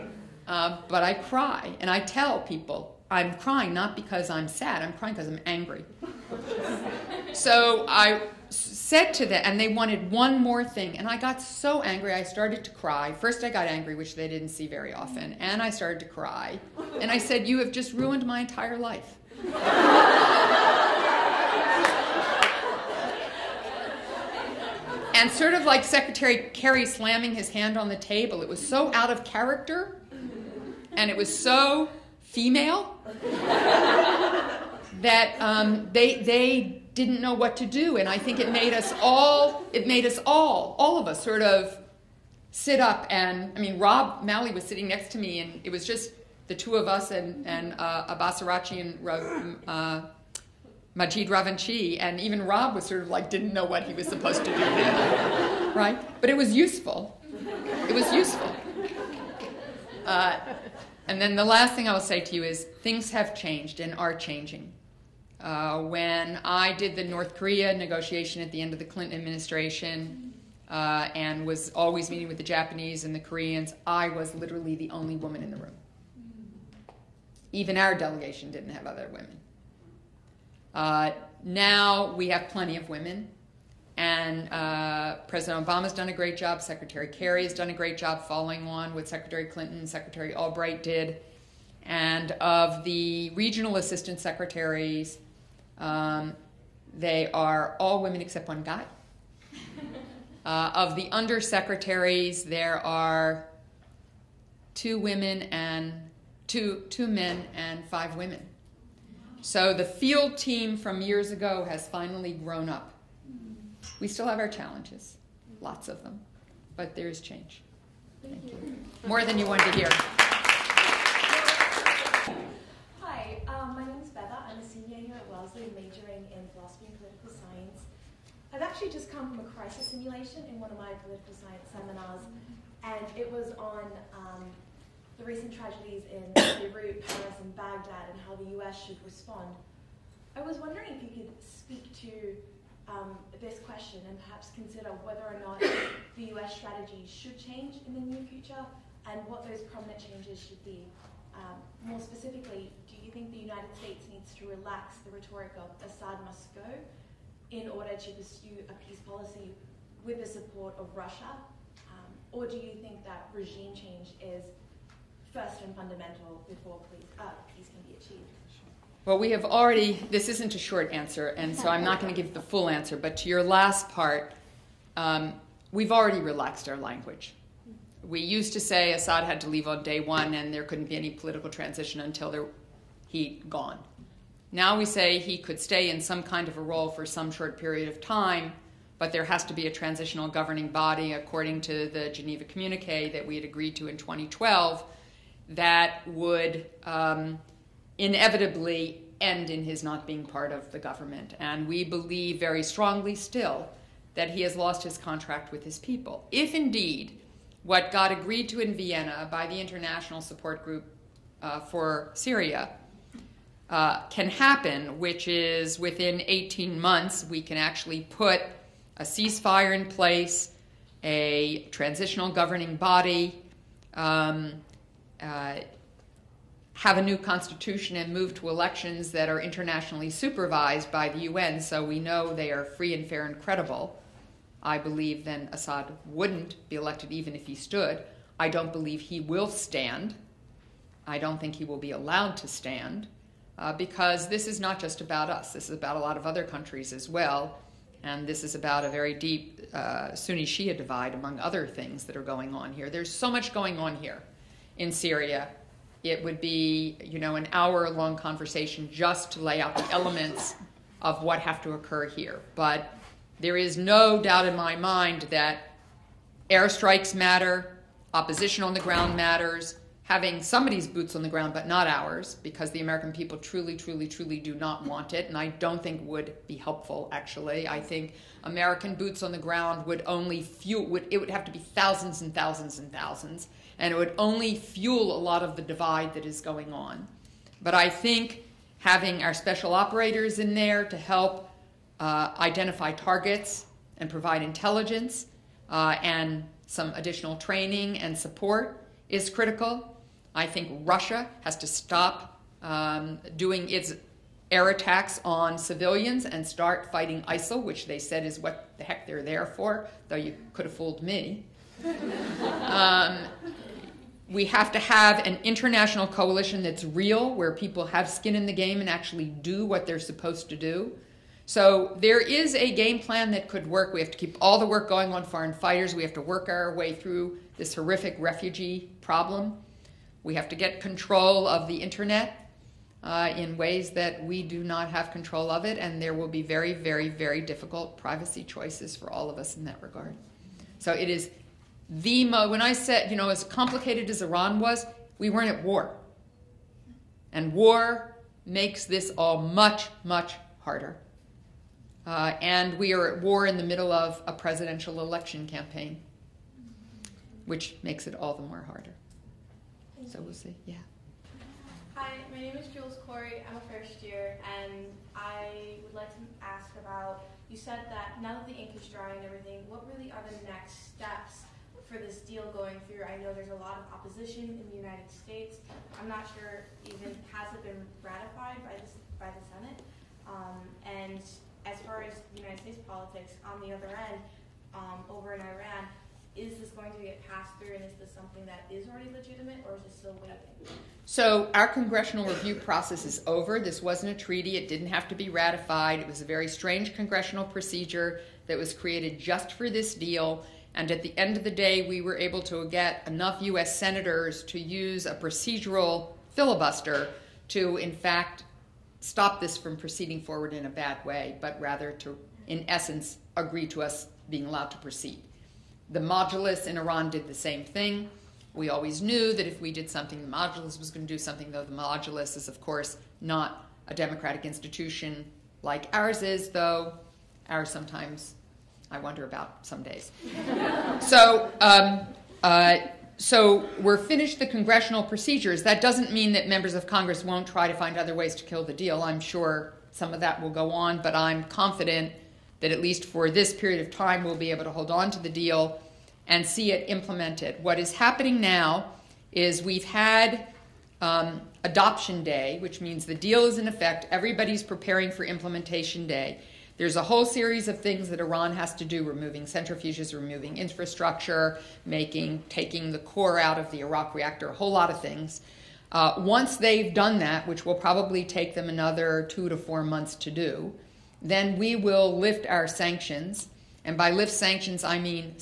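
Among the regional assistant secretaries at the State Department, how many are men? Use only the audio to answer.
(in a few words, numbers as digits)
1.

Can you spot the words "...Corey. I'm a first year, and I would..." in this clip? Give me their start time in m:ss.
6:03.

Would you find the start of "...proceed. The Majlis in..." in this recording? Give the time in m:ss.
6:54.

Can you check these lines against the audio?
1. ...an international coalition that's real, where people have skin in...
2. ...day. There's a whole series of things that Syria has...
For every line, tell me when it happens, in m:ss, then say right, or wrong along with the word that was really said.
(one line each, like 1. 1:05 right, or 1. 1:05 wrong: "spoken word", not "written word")
1. 5:15 right
2. 7:36 wrong: "Iran", not "Syria".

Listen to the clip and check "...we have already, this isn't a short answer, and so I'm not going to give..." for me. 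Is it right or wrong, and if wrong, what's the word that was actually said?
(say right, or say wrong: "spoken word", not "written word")
right.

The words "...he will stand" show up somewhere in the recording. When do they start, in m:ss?
3:59.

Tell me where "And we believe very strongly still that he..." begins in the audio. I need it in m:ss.
3:21.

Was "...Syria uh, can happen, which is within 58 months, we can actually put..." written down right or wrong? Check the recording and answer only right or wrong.
wrong.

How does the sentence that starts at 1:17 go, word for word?
Even our delegation didn't have other women.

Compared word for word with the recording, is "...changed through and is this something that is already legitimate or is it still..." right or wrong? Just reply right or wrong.
wrong.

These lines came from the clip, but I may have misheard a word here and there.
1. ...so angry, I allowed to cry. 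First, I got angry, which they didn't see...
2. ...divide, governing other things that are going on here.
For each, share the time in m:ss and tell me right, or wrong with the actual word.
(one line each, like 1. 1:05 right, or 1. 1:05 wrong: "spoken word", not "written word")
1. 0:11 wrong: "started", not "allowed"
2. 4:10 wrong: "among", not "governing".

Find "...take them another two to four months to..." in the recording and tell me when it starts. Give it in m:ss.
7:48.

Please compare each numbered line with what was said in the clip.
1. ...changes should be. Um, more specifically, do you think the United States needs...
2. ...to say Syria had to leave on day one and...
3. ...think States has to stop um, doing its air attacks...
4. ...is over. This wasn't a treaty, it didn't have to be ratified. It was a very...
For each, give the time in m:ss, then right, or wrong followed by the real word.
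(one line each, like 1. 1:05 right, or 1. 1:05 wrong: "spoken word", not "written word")
1. 2:29 right
2. 2:58 wrong: "Assad", not "Syria"
3. 5:00 wrong: "Russia", not "States"
4. 6:33 right.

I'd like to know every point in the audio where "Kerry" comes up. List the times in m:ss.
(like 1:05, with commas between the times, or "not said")
0:26, 1:27.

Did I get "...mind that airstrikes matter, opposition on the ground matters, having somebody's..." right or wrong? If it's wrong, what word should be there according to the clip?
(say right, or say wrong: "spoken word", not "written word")
right.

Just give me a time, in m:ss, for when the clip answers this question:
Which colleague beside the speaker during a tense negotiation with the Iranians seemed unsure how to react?
0:43.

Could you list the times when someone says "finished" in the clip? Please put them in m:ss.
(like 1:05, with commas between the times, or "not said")
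7:13.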